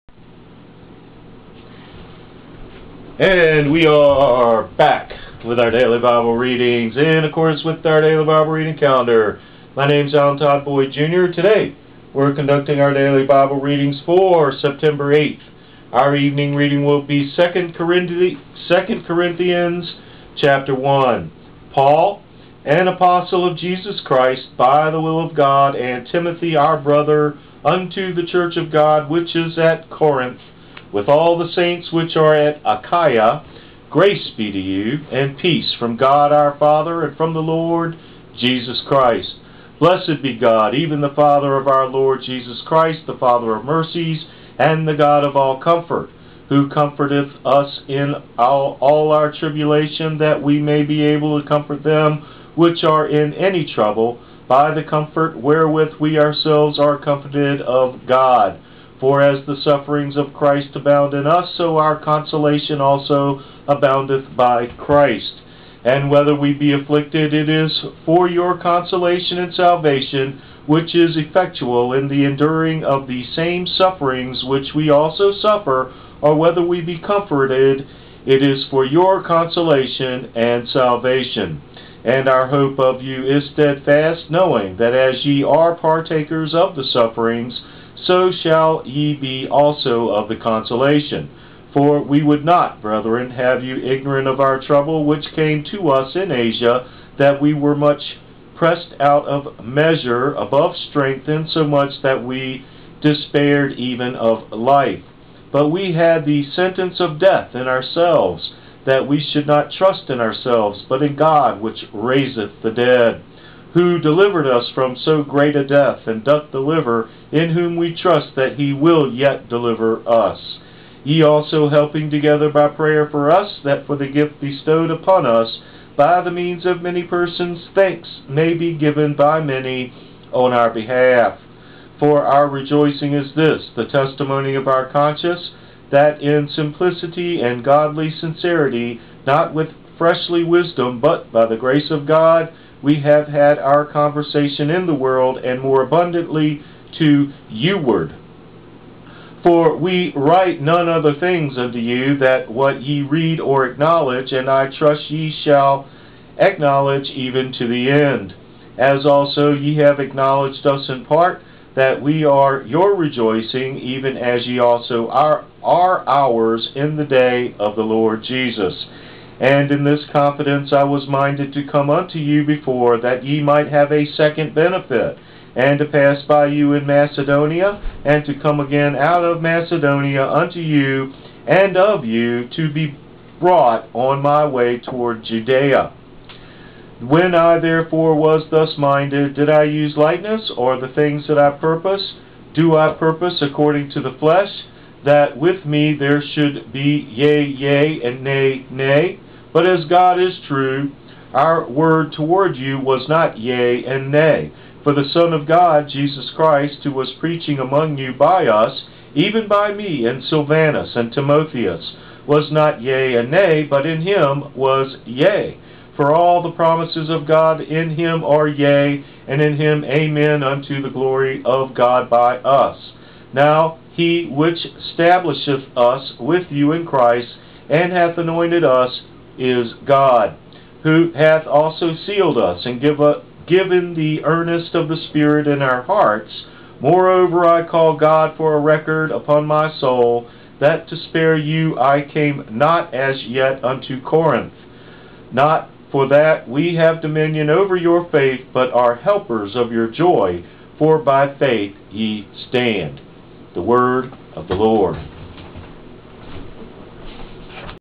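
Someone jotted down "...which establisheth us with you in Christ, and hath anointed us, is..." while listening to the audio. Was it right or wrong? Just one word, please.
right.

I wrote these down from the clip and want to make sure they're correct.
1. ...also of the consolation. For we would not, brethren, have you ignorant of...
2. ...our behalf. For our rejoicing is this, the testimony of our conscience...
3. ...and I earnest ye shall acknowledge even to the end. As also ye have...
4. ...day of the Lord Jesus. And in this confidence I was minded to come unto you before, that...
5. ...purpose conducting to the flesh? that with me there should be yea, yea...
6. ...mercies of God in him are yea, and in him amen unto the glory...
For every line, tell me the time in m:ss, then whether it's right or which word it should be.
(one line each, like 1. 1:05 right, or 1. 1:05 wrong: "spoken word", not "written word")
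1. 1:29 right
2. 2:10 right
3. 2:34 wrong: "trust", not "earnest"
4. 2:47 right
5. 3:12 wrong: "according", not "conducting"
6. 3:36 wrong: "promises", not "mercies".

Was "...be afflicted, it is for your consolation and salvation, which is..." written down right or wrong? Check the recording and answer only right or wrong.
right.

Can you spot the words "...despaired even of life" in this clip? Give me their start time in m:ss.
1:43.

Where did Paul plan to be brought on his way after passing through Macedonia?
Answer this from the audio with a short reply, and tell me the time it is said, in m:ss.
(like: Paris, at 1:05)
Judea, at 3:05.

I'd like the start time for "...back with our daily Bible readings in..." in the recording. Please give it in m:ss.
0:04.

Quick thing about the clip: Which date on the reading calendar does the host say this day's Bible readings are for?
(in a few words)
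September 8th.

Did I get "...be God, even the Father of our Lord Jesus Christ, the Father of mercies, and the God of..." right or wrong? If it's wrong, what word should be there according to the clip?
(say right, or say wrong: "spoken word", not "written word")
right.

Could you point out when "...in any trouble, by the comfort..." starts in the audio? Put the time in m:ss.
0:53.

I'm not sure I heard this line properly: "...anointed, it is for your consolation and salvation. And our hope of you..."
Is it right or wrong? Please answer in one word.
wrong.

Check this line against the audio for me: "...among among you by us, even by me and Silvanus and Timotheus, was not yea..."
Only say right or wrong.
wrong.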